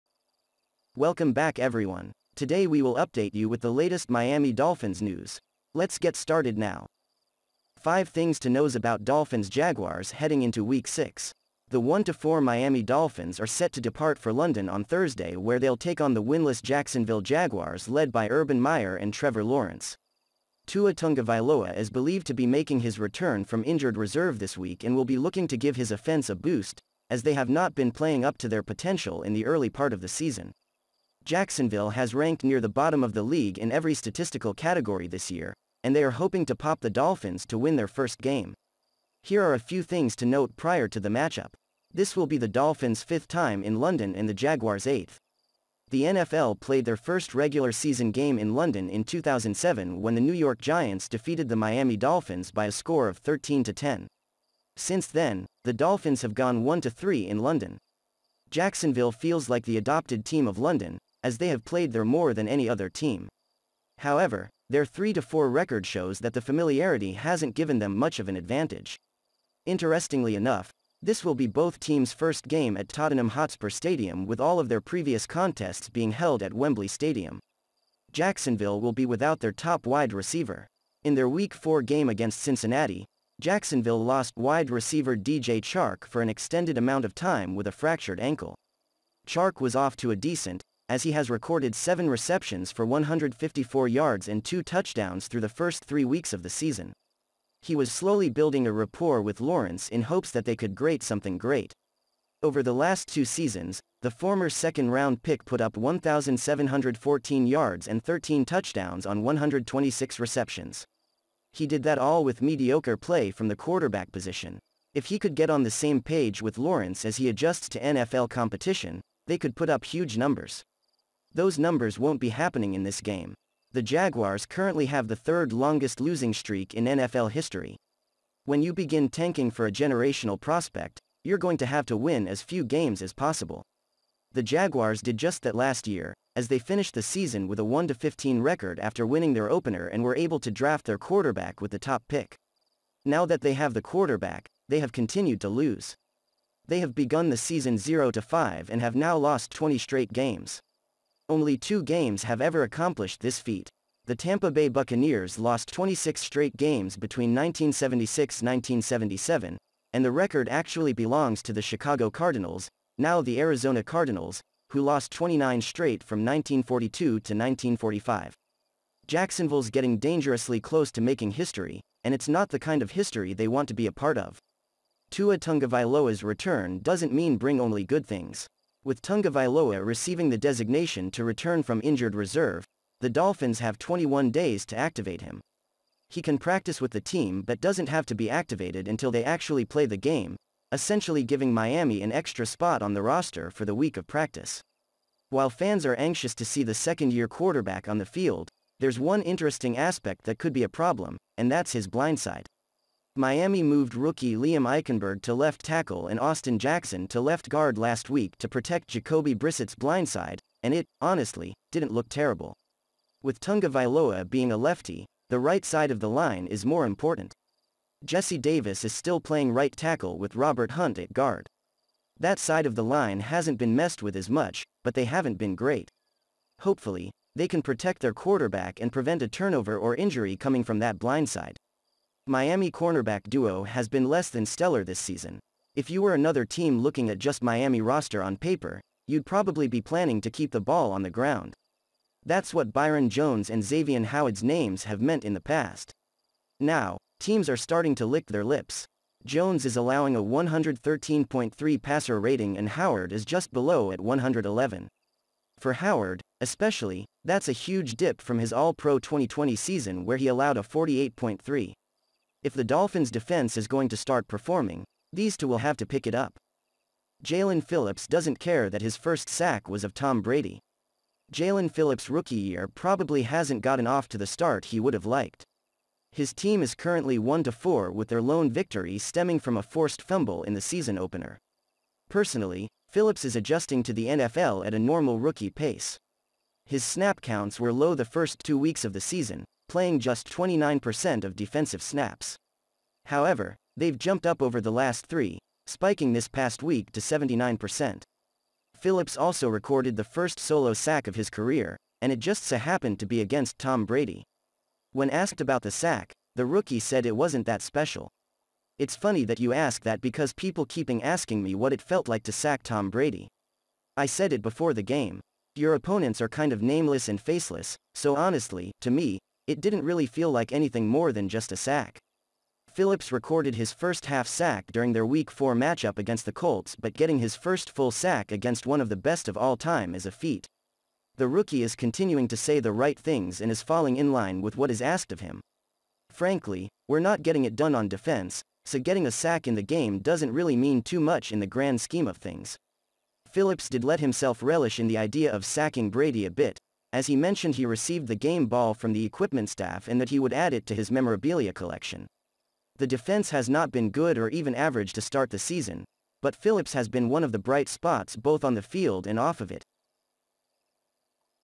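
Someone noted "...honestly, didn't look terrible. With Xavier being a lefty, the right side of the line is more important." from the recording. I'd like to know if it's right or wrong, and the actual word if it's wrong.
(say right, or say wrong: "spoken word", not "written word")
wrong: "Tagovailoa", not "Xavier".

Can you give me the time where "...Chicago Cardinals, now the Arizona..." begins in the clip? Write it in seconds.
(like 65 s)
161 s.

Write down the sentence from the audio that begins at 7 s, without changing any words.
5 things to knows about Dolphins Jaguars heading into week 6.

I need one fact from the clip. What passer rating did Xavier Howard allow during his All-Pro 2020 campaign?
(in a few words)
48.3.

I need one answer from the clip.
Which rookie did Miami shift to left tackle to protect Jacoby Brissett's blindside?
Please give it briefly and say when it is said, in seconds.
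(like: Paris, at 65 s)
Liam Eichenberg, at 204 s.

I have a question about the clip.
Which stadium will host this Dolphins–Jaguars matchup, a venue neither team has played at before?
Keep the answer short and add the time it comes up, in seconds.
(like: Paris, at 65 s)
Tottenham Hotspur Stadium, at 72 s.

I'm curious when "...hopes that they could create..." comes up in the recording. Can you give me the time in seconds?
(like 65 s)
100 s.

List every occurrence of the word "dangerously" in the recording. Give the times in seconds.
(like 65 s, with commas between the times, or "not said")
169 s.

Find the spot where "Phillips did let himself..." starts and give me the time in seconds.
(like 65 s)
343 s.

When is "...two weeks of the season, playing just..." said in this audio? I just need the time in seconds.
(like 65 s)
288 s.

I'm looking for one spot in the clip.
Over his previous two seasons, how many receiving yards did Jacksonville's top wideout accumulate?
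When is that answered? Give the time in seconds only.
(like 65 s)
105 s.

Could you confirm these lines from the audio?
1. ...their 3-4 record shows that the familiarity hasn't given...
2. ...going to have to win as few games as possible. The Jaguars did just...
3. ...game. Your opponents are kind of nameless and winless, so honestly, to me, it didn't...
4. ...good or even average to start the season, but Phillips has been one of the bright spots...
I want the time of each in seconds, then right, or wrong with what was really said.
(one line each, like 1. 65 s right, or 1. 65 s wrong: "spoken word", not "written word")
1. 64 s right
2. 131 s right
3. 314 s wrong: "faceless", not "winless"
4. 353 s right.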